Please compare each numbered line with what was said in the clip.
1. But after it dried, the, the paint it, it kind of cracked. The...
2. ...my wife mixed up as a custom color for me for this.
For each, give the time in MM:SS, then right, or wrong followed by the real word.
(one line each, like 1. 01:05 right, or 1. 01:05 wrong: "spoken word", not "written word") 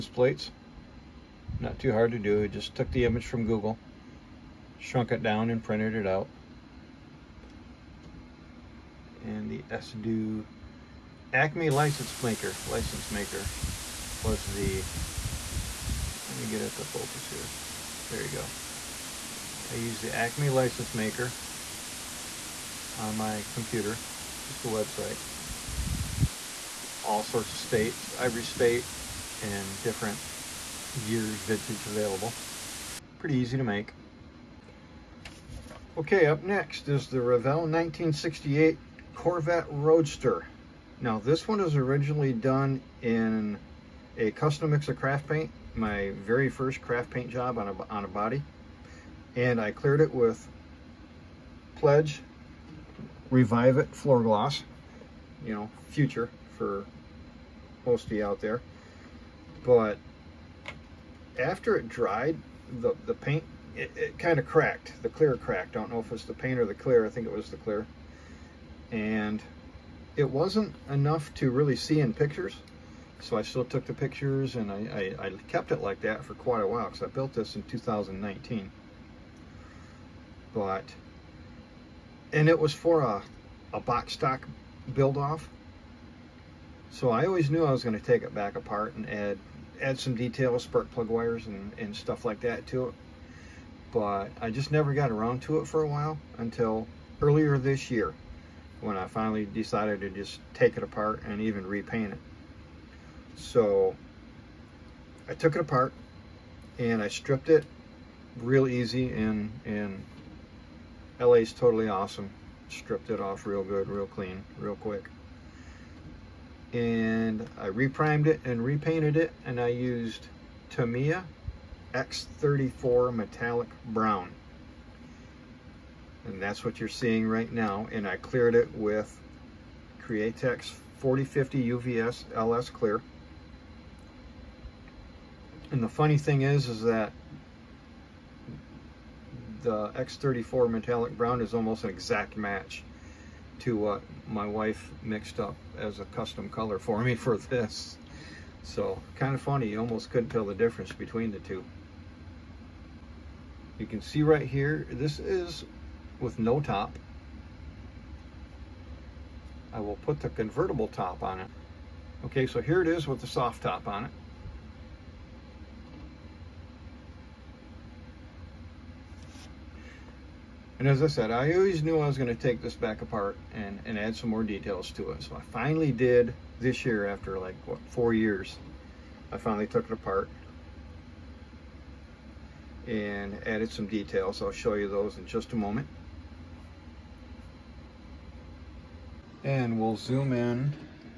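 1. 00:59 right
2. 02:24 right.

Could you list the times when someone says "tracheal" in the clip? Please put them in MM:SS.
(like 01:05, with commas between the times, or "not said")
not said.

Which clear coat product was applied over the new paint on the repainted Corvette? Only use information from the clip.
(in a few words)
Createx 4050 UVLS Clear.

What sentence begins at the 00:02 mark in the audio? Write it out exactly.
I just took the image from Google shrunk it down and printed it out.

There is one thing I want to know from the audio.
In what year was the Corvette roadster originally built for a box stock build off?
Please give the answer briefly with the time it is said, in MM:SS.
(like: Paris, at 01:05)
2019, at 01:17.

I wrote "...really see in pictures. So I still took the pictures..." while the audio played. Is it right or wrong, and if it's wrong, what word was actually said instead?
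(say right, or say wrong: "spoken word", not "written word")
right.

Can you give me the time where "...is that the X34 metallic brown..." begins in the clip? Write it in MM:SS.
02:16.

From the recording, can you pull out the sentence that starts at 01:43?
So I took it apart and I stripped it real easy and, and LA's totally awesome.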